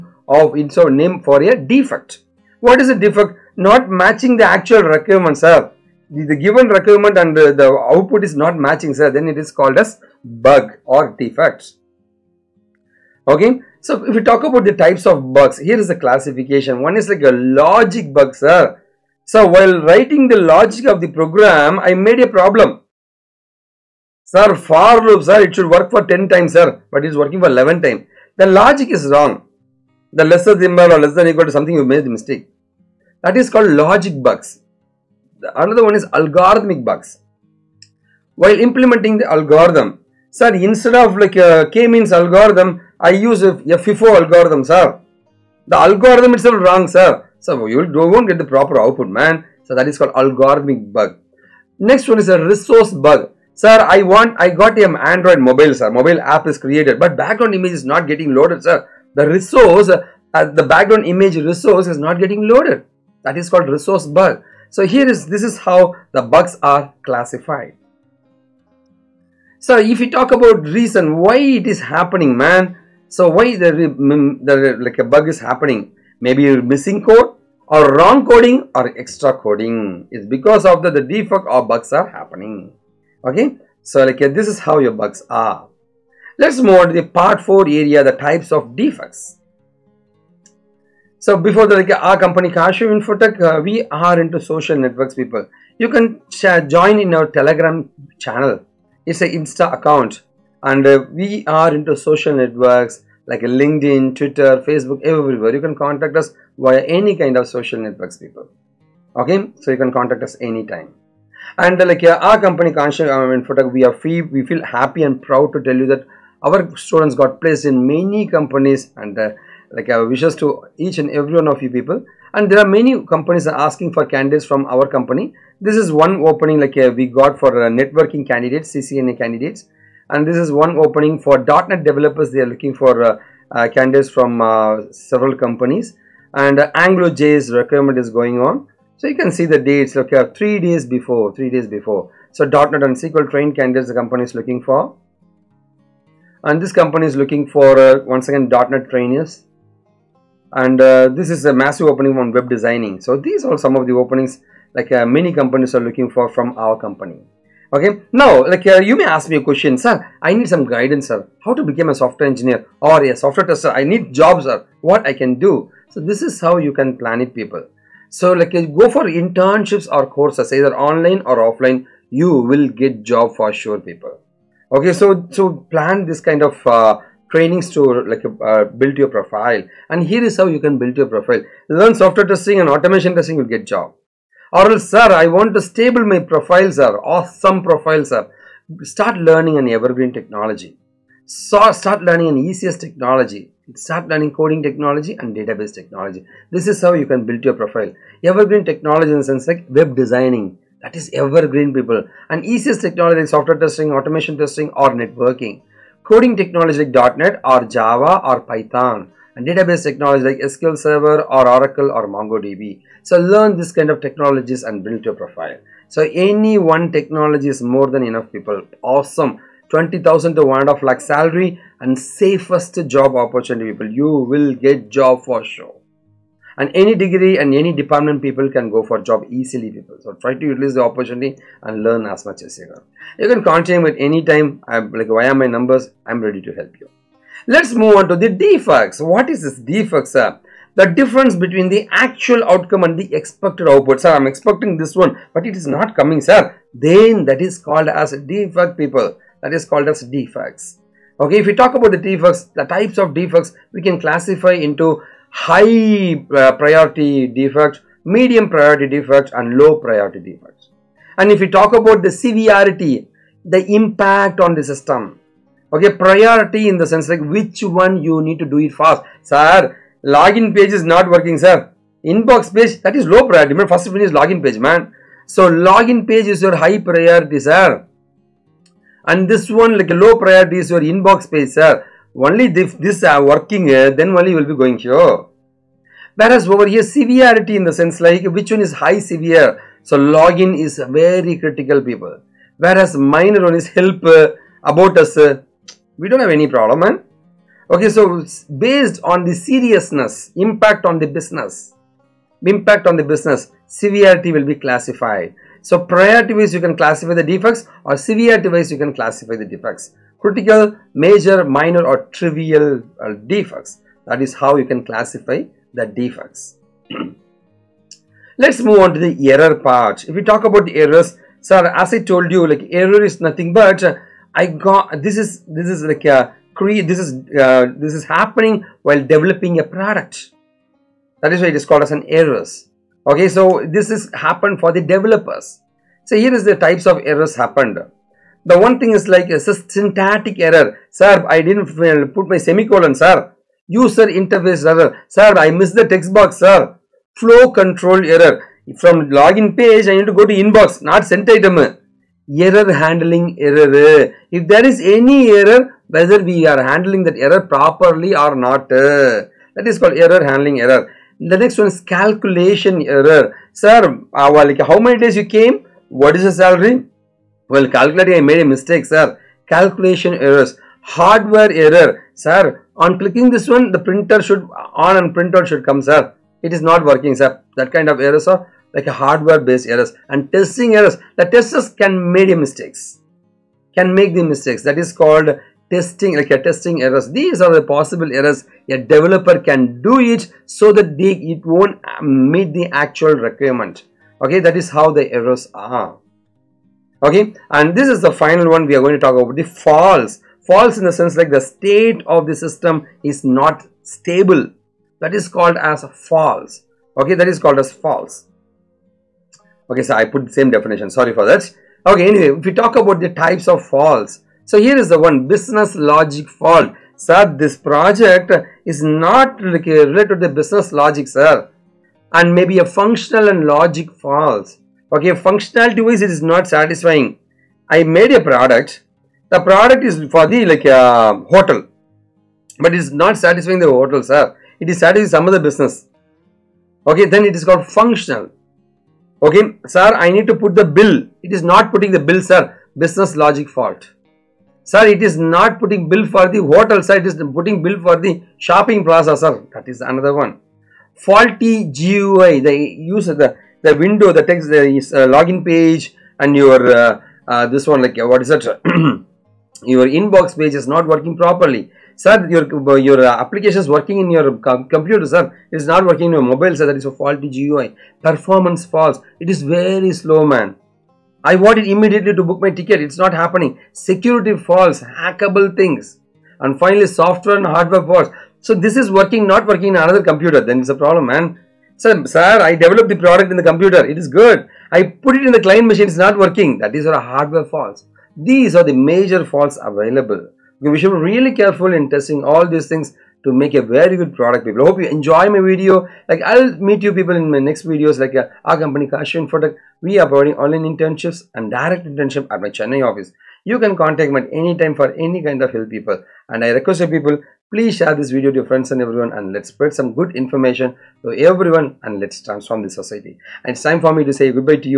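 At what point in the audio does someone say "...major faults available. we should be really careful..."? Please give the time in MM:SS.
08:08.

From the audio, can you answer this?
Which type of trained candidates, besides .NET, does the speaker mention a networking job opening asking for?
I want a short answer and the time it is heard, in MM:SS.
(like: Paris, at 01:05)
CCNA, at 02:08.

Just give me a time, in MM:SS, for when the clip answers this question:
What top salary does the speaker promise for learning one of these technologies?
03:40.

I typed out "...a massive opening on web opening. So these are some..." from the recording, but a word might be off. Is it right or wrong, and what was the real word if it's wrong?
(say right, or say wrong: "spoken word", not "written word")
wrong: "designing", not "opening".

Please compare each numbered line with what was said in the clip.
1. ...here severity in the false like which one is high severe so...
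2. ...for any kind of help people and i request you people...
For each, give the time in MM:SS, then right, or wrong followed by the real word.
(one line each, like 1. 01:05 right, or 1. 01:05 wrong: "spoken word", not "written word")
1. 04:46 wrong: "sense", not "false"
2. 08:24 right.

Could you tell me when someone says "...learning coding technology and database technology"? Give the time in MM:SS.
03:14.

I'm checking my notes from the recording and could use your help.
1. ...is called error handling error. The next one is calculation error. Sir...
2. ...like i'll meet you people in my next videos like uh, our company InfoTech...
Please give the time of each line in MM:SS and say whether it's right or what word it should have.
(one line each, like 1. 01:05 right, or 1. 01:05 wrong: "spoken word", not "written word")
1. 05:59 right
2. 08:16 wrong: "KaaShiv", not "InfoTech".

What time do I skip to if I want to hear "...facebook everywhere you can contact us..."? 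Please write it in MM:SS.
01:44.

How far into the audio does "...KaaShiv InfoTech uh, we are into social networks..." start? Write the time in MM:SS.
01:32.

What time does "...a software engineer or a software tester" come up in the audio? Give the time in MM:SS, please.
02:41.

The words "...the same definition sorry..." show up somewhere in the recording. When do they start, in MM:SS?
06:50.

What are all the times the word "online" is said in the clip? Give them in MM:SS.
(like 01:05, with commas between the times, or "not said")
02:50, 08:20.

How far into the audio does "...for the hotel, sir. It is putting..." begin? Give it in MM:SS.
07:26.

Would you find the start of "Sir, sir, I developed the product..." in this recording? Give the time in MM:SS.
08:01.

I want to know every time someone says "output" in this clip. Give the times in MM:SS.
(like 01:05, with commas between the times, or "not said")
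00:07, 00:48, 04:03.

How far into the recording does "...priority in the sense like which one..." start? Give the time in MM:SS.
04:25.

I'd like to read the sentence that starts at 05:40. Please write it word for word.
Sir, I didn't put my semicolon, sir.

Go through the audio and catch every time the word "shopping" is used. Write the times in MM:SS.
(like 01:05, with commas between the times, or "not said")
07:28.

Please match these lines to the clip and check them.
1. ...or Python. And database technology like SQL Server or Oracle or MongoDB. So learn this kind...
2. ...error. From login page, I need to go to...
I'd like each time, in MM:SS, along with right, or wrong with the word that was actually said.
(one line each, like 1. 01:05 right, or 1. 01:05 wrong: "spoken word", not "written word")
1. 03:28 right
2. 05:48 right.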